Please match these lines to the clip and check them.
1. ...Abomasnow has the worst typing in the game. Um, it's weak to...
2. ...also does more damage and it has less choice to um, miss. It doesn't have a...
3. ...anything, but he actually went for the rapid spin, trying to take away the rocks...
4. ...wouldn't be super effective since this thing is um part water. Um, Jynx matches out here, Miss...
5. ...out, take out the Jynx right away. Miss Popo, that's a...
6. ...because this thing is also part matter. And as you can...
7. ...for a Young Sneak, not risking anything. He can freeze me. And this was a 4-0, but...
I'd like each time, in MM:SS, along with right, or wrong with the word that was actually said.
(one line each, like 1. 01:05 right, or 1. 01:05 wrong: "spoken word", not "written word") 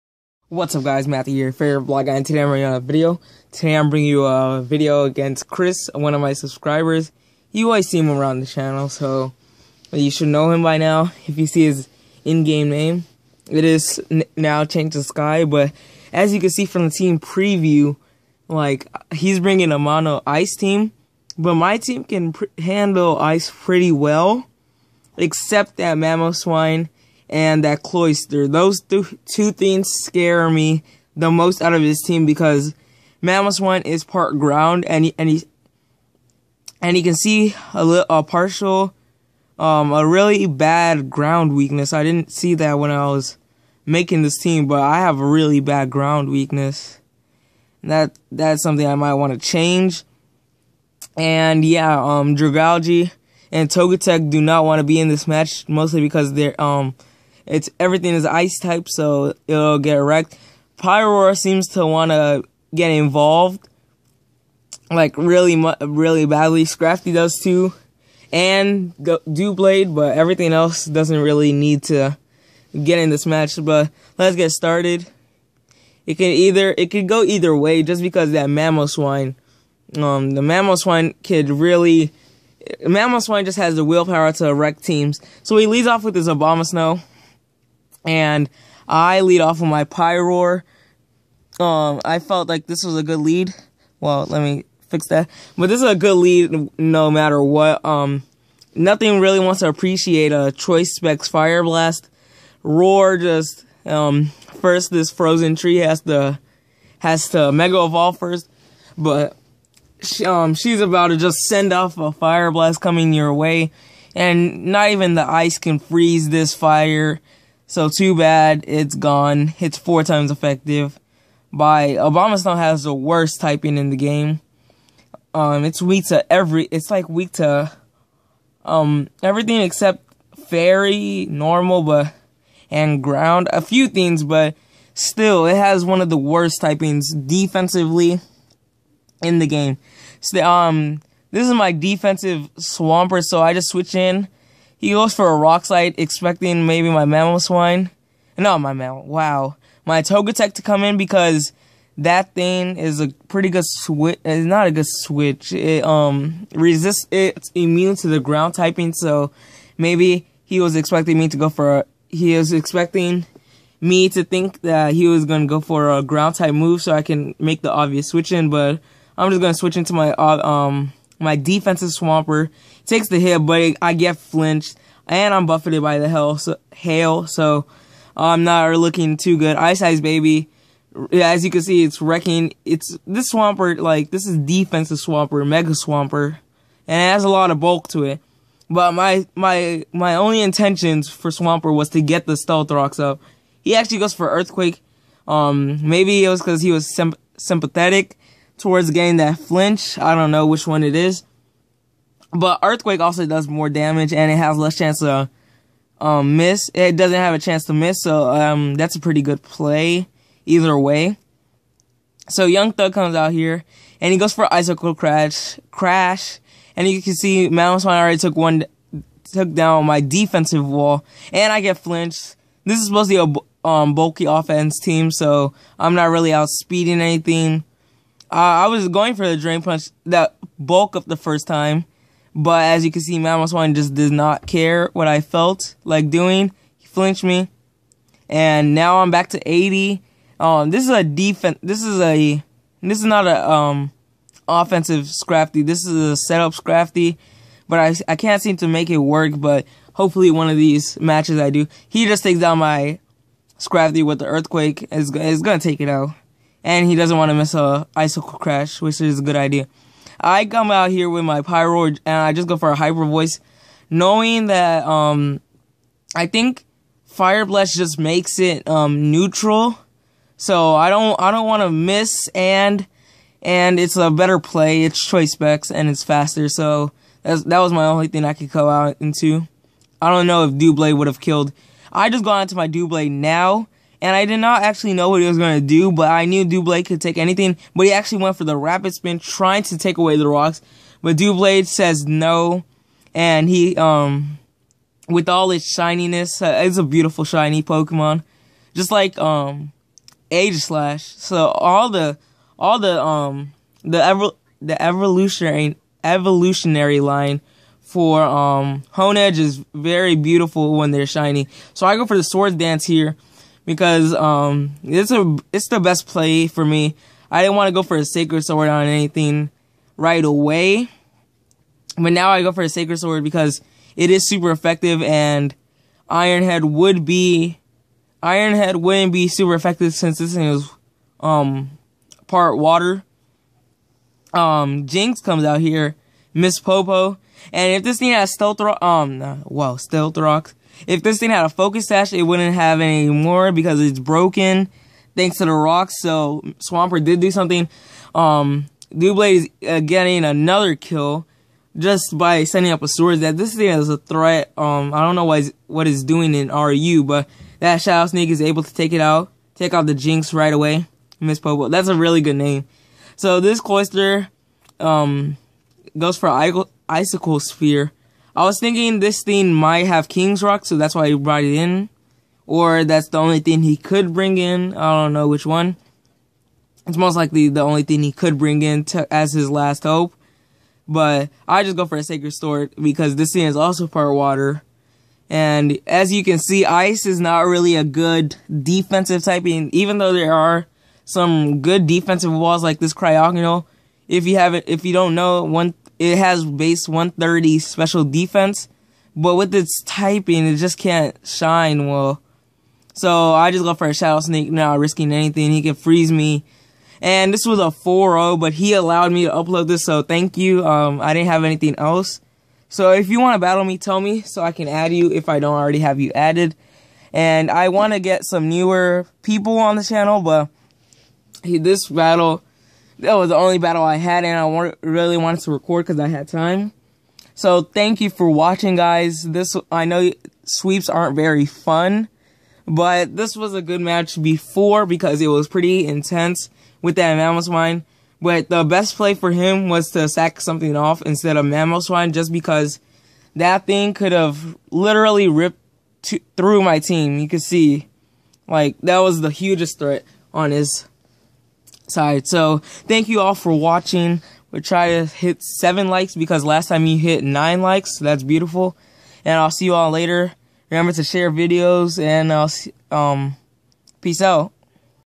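1. 02:01 right
2. 03:23 wrong: "chance", not "choice"
3. 04:47 right
4. 05:28 wrong: "comes", not "matches"
5. 05:59 right
6. 06:22 wrong: "water", not "matter"
7. 06:43 wrong: "Shadow", not "Young".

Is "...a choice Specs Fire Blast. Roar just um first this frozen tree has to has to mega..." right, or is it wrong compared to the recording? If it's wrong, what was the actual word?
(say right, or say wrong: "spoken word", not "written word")
right.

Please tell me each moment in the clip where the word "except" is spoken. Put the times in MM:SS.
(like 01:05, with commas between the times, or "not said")
00:25, 02:09.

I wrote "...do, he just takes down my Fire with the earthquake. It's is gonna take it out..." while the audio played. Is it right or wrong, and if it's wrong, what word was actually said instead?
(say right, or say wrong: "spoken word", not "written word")
wrong: "Scrafty", not "Fire".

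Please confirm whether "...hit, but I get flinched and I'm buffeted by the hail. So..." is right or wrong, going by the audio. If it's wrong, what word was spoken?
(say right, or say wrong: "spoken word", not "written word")
right.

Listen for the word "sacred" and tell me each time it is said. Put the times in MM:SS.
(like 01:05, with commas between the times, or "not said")
05:18, 05:22, 06:22.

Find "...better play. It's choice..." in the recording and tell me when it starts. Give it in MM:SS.
04:34.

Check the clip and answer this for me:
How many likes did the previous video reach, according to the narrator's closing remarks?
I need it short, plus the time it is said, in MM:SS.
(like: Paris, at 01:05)
9, at 07:37.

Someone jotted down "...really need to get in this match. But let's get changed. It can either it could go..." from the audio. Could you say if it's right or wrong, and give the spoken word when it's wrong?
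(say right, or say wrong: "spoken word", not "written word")
wrong: "started", not "changed".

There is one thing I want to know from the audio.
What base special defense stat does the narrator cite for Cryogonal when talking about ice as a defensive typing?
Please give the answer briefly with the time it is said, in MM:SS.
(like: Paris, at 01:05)
130, at 06:36.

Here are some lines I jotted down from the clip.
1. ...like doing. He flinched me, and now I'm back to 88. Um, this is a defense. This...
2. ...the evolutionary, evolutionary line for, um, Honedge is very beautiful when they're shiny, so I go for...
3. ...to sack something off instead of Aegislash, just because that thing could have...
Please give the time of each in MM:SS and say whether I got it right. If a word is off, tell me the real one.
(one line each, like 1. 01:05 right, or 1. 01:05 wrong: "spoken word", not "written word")
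1. 03:55 wrong: "80", not "88"
2. 05:04 right
3. 07:19 wrong: "Mamoswine", not "Aegislash".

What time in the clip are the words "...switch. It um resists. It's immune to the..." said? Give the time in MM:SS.
02:34.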